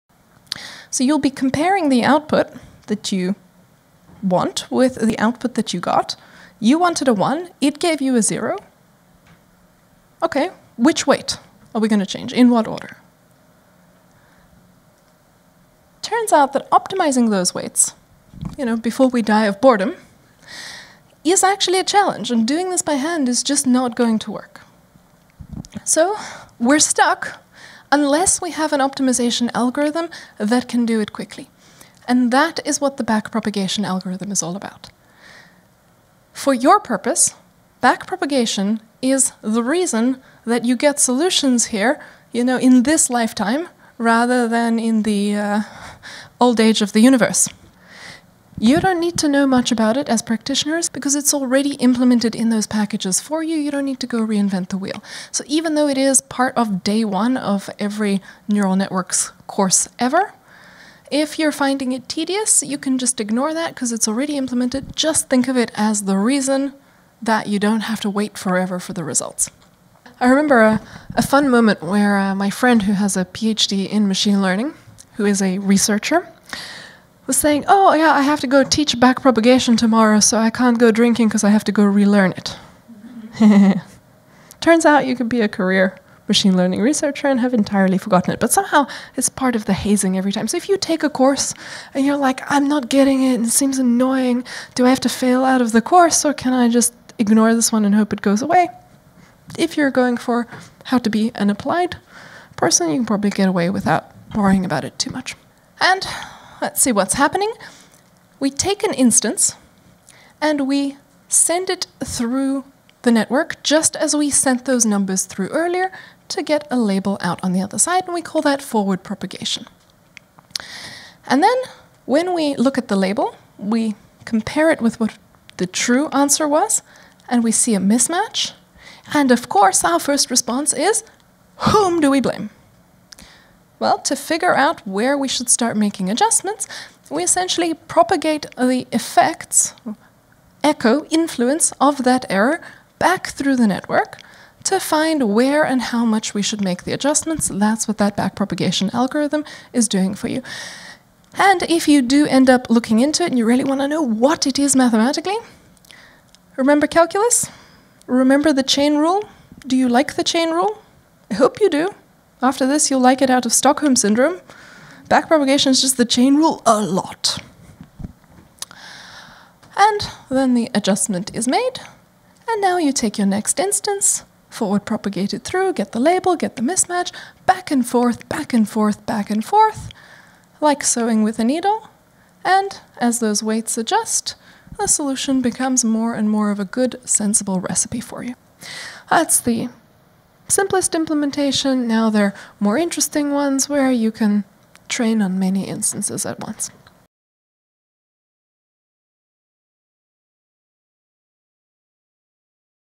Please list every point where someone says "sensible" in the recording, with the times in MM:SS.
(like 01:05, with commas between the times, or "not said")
03:07.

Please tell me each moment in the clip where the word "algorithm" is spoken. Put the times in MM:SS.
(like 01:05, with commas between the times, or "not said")
00:29, 00:33, 02:28.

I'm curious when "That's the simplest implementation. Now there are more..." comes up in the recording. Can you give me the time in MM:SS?
03:09.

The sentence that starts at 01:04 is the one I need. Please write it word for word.
Just think of it as the reason that you don't have to wait forever for the results.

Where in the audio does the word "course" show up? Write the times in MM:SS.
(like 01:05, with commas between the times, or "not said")
00:59, 01:31, 01:35, 02:09.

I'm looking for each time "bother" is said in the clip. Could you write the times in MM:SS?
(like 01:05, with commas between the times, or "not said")
not said.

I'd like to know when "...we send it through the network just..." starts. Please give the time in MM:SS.
01:50.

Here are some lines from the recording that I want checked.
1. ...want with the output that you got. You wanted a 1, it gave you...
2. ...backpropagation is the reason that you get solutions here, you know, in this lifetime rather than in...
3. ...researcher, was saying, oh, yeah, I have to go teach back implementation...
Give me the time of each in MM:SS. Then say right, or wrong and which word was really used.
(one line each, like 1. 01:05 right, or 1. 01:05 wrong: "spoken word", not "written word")
1. 00:04 right
2. 00:37 right
3. 01:15 wrong: "propagation", not "implementation".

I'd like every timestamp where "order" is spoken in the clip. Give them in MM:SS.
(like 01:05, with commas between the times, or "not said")
00:12.